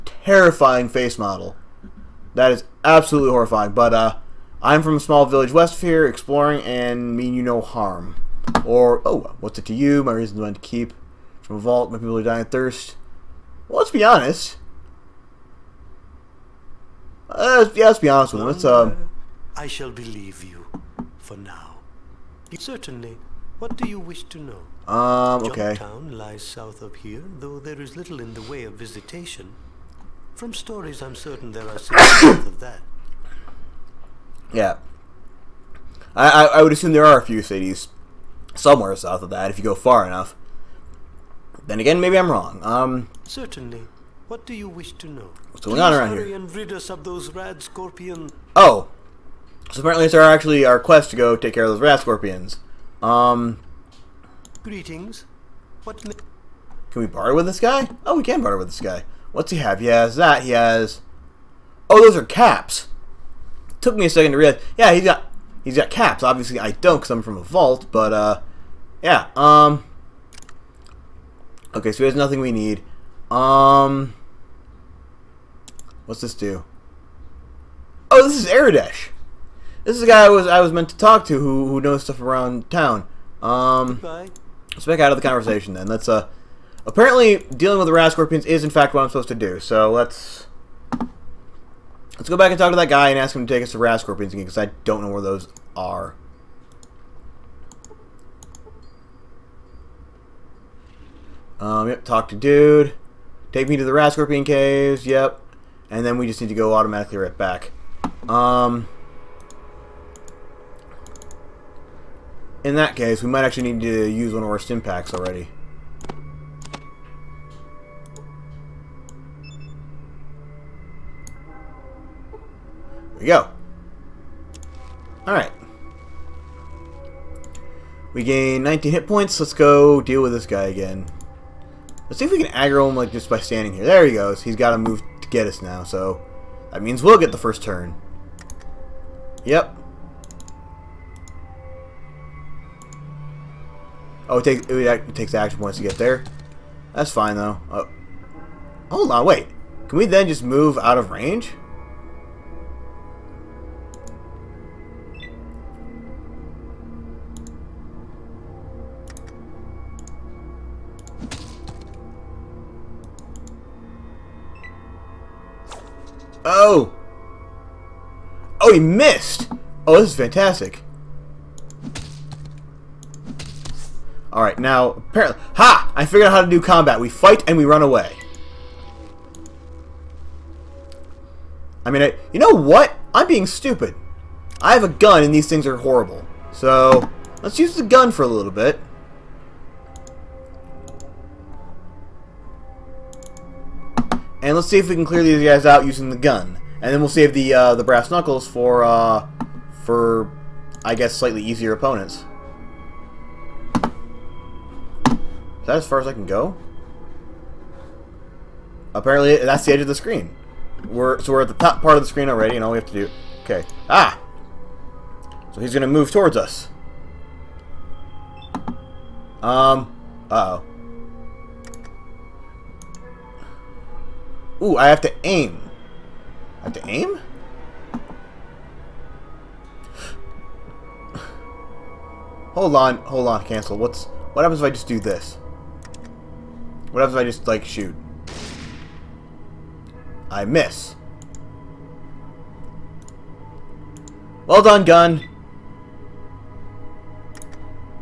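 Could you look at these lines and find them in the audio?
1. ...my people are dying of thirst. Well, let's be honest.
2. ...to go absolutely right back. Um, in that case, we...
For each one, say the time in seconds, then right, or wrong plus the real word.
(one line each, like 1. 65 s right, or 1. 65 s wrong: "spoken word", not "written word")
1. 11 s right
2. 106 s wrong: "automatically", not "absolutely".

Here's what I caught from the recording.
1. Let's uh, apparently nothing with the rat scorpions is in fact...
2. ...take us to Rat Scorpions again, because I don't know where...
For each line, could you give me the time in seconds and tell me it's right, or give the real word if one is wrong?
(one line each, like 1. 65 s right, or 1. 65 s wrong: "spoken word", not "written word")
1. 85 s wrong: "dealing", not "nothing"
2. 93 s right.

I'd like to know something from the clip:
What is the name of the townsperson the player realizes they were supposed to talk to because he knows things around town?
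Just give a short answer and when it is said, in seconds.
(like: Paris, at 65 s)
Aradesh, at 78 s.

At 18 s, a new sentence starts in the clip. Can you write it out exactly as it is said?
Let's, uh, I shall believe you for now.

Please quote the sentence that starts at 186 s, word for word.
So, let's use the gun for a little bit.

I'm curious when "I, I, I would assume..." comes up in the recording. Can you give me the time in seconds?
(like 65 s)
36 s.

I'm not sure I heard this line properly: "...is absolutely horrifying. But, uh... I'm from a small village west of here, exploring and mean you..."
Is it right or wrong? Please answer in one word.
right.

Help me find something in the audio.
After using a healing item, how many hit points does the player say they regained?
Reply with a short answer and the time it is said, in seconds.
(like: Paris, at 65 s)
19, at 128 s.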